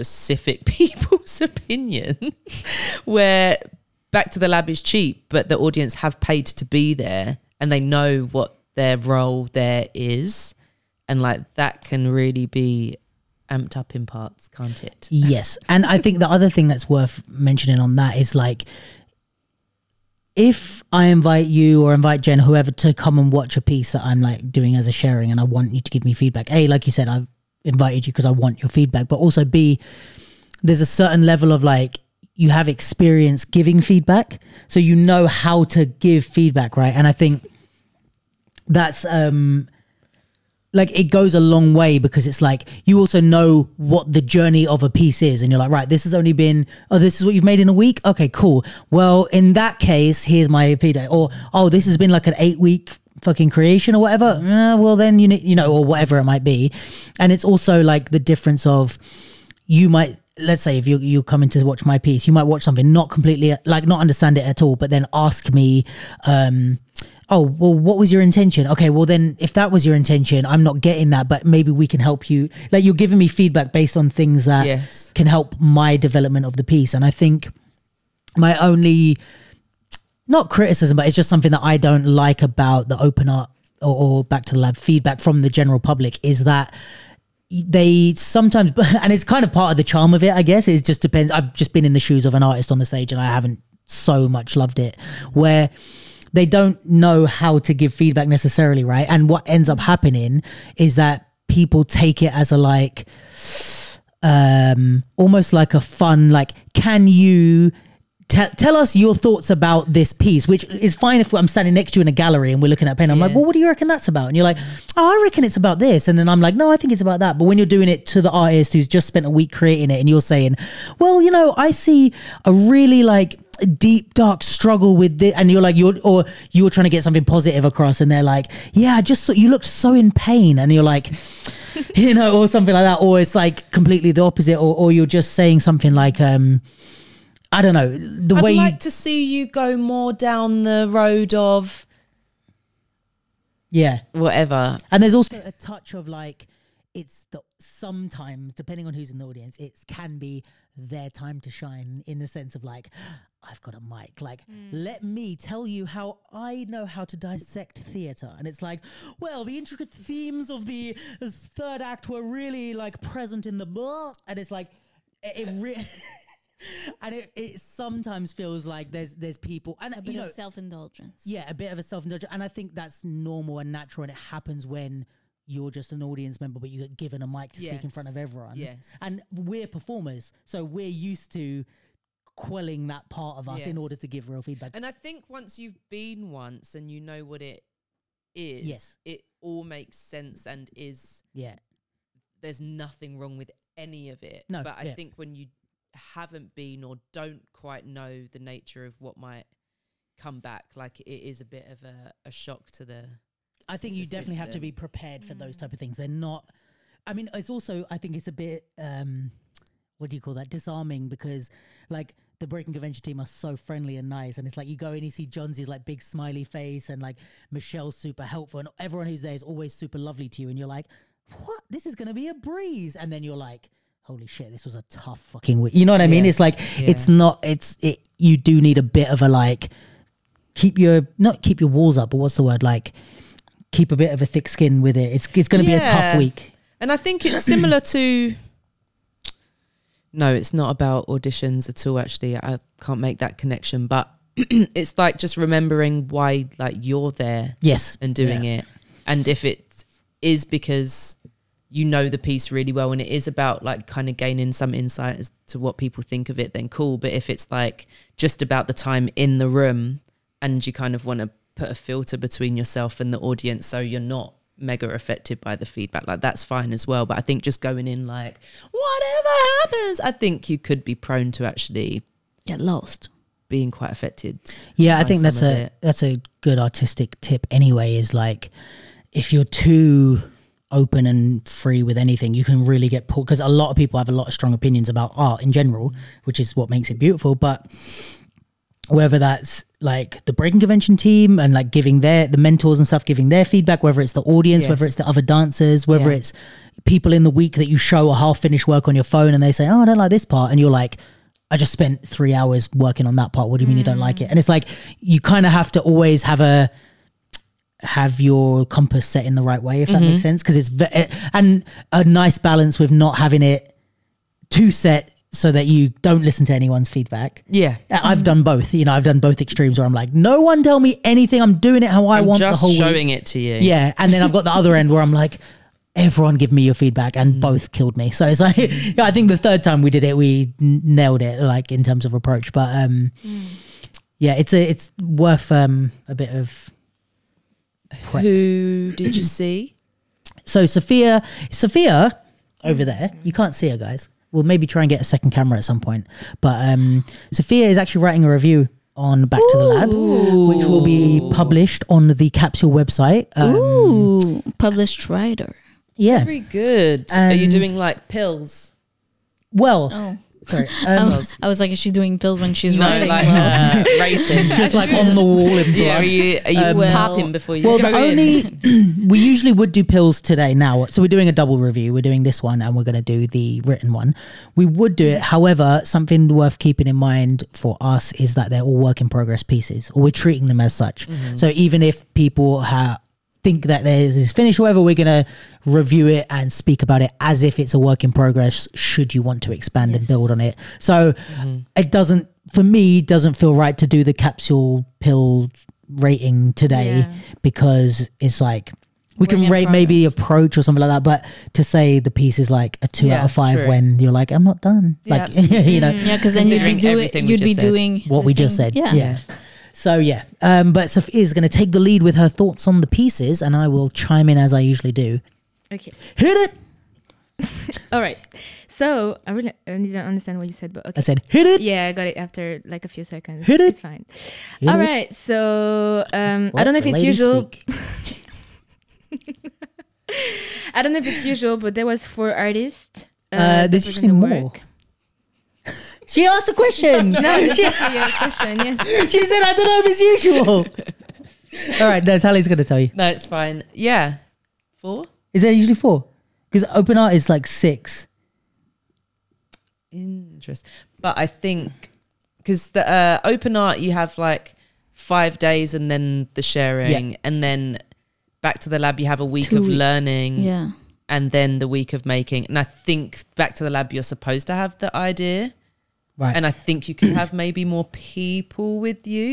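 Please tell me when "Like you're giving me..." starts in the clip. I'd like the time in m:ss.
1:12.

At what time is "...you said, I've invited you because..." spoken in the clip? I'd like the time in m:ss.
0:26.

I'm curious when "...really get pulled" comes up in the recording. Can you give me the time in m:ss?
4:42.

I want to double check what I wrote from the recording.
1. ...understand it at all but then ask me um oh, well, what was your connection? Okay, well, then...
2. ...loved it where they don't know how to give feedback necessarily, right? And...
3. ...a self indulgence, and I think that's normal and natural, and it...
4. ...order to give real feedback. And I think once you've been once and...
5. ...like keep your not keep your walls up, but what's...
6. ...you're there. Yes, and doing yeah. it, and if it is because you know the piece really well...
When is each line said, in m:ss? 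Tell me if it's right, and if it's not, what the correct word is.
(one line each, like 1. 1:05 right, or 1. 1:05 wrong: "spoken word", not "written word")
1. 1:04 wrong: "intention", not "connection"
2. 1:34 right
3. 2:51 right
4. 3:03 right
5. 3:49 right
6. 4:06 right.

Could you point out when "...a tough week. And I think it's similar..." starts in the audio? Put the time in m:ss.
3:55.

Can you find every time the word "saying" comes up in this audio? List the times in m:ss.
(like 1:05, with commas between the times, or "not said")
2:00, 2:15.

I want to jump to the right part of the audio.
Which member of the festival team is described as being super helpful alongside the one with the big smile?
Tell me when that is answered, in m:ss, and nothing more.
3:37.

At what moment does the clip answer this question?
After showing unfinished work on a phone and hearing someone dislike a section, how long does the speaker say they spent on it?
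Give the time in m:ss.
5:02.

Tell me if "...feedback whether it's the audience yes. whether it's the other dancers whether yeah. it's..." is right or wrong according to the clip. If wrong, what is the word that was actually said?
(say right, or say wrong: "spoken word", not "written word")
right.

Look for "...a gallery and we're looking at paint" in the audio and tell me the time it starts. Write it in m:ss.
1:52.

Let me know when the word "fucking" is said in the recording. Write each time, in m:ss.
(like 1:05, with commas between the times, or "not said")
0:53, 3:45.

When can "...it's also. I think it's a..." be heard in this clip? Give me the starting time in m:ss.
3:27.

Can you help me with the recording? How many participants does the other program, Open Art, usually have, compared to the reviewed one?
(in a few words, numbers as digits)
6.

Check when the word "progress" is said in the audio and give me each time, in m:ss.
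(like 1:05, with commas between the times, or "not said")
6:19, 6:28, 6:39.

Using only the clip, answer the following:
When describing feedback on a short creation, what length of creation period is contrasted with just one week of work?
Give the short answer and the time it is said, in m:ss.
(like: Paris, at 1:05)
8 weeks, at 0:52.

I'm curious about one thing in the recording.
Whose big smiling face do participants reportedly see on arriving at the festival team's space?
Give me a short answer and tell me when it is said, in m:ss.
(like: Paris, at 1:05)
Jonzi, at 3:35.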